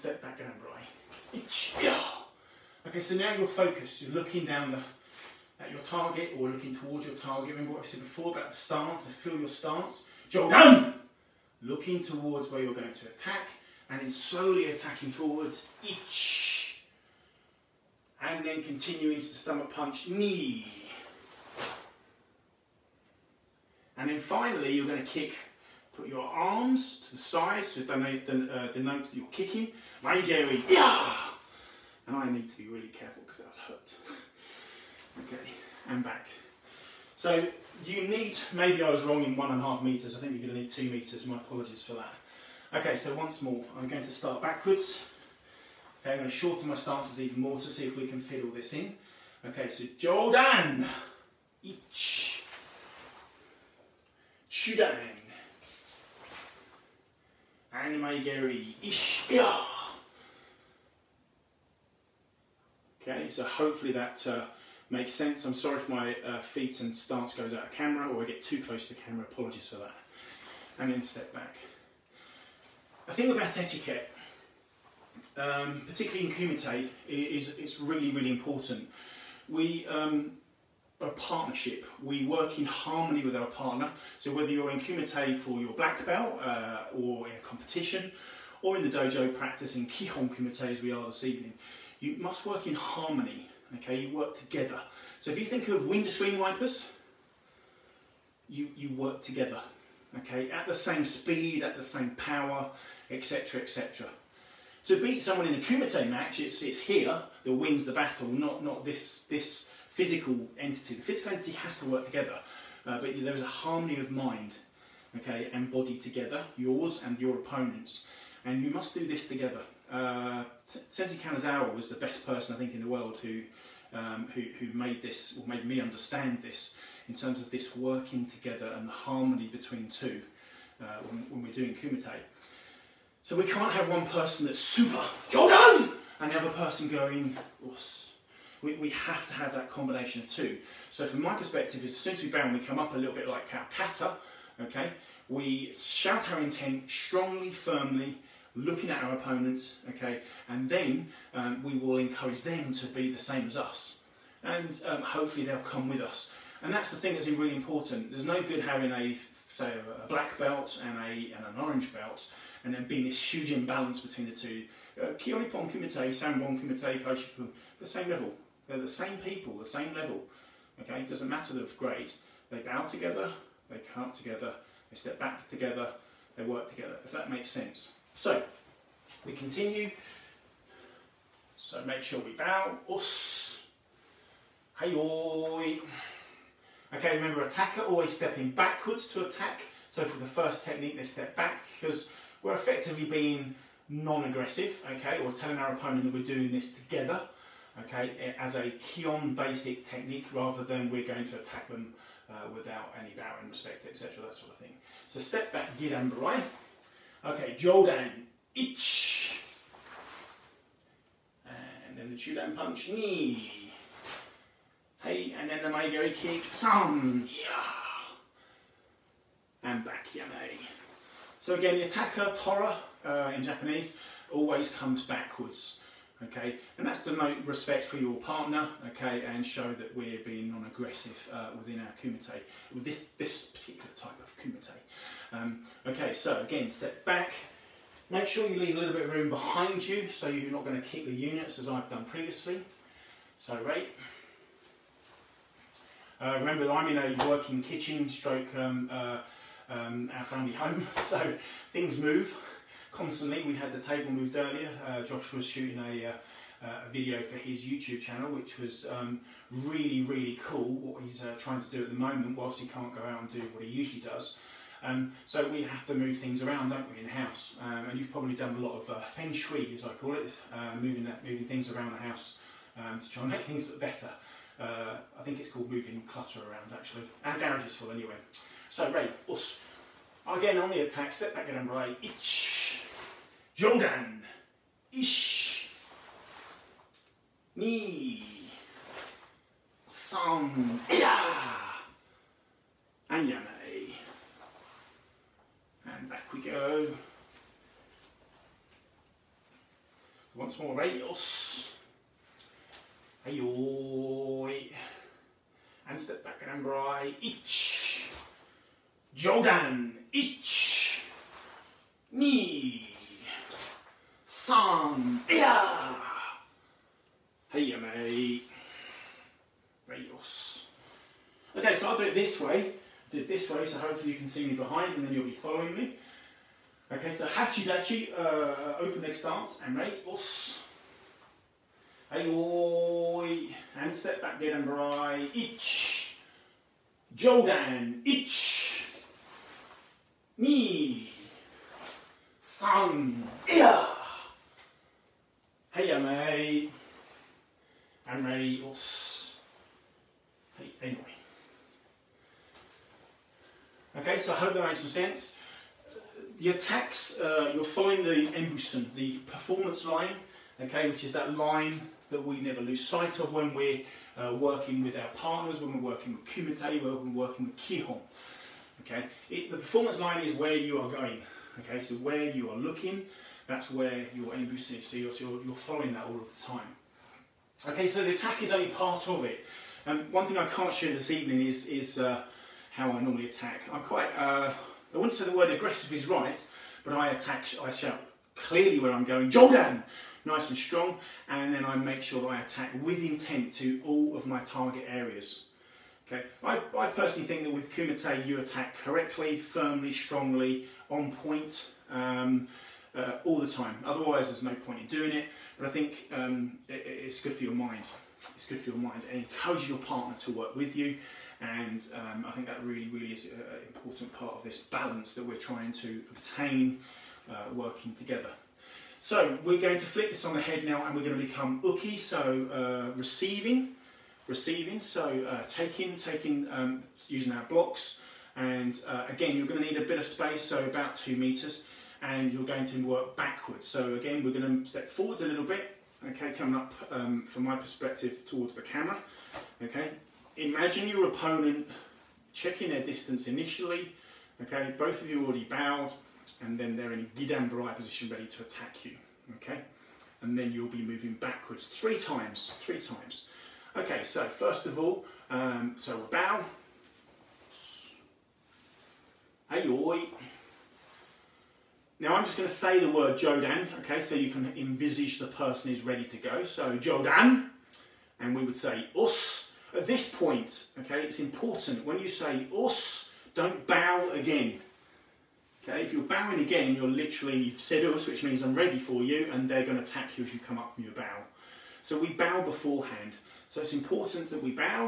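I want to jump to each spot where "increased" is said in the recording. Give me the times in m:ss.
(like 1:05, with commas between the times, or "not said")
not said.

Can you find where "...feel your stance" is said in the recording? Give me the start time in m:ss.
0:09.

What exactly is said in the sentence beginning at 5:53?
Okay, so I hope that made some sense.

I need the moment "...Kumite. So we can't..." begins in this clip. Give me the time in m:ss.
2:11.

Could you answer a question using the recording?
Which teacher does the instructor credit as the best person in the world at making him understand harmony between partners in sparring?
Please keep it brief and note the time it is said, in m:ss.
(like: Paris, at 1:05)
Sensei Kanazawa, at 2:00.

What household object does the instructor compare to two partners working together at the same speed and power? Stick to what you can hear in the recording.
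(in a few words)
Windscreen wipers.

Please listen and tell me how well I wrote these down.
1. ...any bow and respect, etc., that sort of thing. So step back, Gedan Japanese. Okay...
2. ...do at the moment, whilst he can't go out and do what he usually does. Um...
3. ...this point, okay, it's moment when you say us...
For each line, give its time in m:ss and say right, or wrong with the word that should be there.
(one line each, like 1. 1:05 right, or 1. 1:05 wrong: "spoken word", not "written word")
1. 3:22 wrong: "Barai", not "Japanese"
2. 4:21 right
3. 7:49 wrong: "important", not "moment".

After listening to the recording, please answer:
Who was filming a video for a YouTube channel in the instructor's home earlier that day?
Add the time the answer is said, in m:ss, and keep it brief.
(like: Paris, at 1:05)
Josh, at 4:15.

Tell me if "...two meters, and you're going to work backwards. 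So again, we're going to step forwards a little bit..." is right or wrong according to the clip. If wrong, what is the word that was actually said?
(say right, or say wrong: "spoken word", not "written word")
right.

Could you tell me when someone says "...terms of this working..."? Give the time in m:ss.
2:07.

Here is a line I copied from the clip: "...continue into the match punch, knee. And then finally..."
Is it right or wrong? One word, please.
wrong.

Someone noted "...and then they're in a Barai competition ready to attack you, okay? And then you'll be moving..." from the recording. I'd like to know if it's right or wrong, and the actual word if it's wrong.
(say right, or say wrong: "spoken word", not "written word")
wrong: "position", not "competition".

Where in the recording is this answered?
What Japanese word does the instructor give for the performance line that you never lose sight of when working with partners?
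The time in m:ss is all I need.
5:58.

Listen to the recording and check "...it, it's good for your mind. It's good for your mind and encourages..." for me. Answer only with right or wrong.
right.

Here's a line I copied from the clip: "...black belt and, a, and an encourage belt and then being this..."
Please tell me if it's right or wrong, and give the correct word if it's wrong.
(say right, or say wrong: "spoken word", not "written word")
wrong: "orange", not "encourage".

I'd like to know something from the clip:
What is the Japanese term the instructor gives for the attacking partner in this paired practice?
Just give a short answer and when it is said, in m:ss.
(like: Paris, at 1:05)
Tora, at 3:42.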